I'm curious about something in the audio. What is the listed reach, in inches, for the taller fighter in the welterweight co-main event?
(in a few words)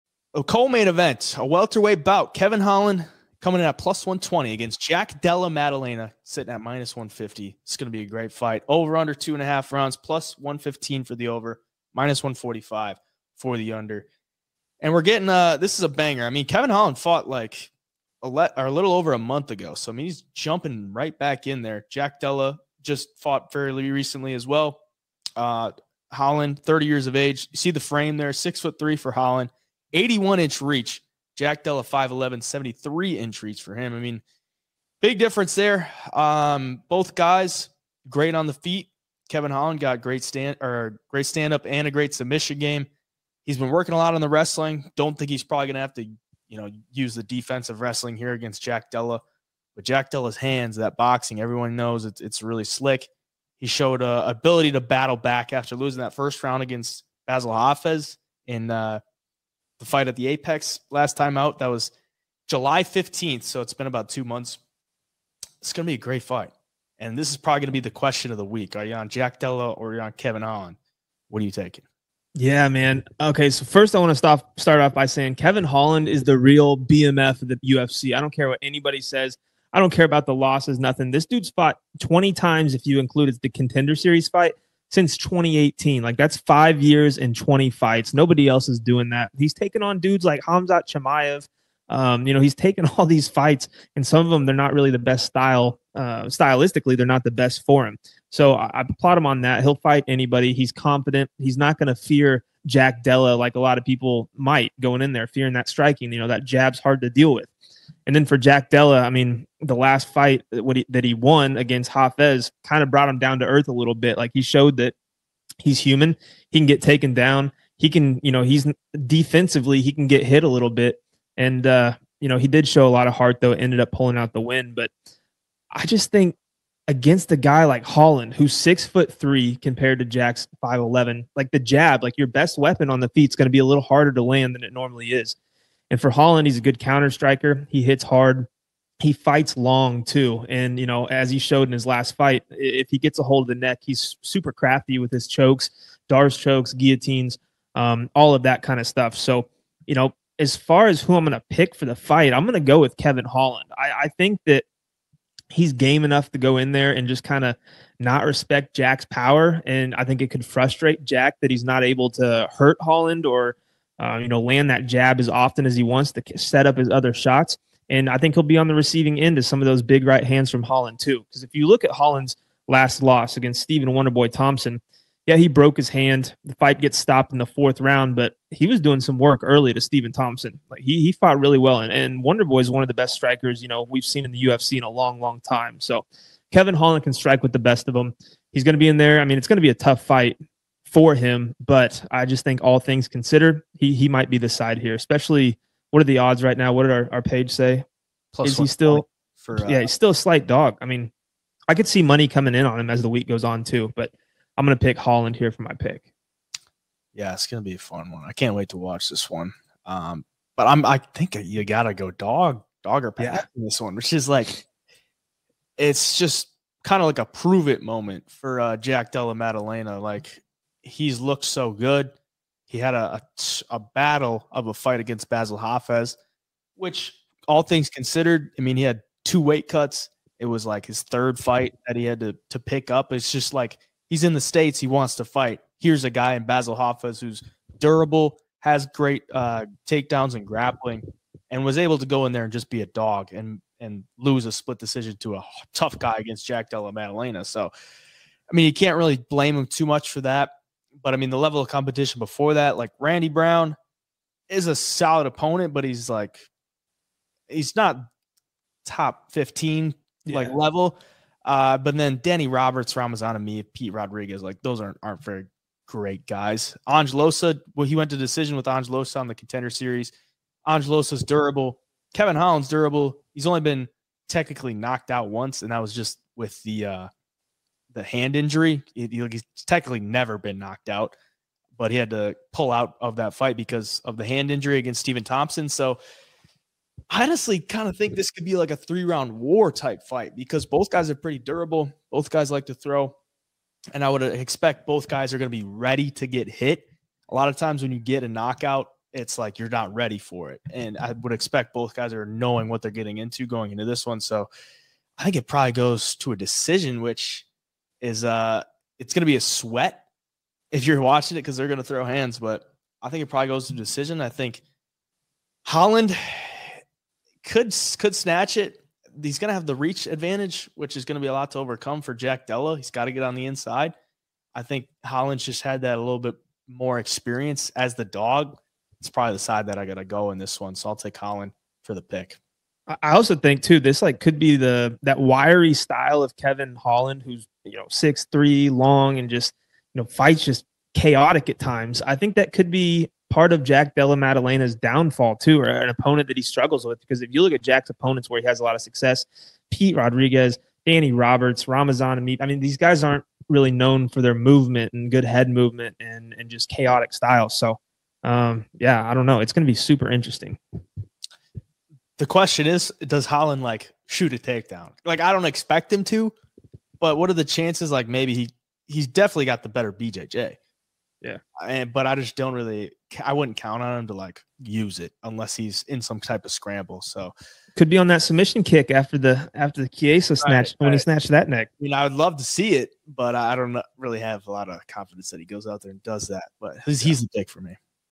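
81.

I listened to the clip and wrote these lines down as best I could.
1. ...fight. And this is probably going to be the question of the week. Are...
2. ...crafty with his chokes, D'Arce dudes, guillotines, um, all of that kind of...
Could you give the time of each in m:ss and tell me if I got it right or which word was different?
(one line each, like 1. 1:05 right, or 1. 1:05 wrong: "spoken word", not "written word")
1. 1:06 right
2. 2:24 wrong: "chokes", not "dudes".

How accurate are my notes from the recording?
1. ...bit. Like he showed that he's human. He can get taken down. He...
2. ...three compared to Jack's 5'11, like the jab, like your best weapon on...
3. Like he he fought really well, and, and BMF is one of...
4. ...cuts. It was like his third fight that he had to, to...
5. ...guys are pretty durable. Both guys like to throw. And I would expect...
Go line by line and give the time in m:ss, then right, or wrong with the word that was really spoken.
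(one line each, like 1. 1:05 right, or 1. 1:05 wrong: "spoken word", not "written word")
1. 1:53 right
2. 2:09 right
3. 3:00 wrong: "Wonderboy", not "BMF"
4. 3:49 right
5. 4:50 right.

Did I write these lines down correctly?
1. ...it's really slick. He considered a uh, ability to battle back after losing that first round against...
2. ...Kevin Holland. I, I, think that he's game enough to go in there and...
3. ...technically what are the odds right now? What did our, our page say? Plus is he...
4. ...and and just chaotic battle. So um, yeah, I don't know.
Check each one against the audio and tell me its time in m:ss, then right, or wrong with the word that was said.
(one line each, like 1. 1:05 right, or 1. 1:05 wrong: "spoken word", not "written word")
1. 0:52 wrong: "showed", not "considered"
2. 2:32 right
3. 3:14 wrong: "especially", not "technically"
4. 5:55 wrong: "style", not "battle".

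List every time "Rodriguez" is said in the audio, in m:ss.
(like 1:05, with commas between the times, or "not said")
4:23, 5:49.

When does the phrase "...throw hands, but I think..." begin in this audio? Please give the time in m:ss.
5:11.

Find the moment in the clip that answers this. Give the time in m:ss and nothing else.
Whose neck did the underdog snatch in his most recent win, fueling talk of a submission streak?
6:19.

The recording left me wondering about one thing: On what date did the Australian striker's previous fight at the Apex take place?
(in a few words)
July 15th.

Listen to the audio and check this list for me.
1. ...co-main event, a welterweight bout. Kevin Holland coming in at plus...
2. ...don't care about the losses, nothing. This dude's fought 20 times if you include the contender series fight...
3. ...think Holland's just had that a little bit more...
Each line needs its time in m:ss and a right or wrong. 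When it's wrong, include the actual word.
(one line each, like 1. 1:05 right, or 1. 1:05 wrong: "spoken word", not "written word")
1. 0:00 right
2. 1:19 right
3. 5:24 right.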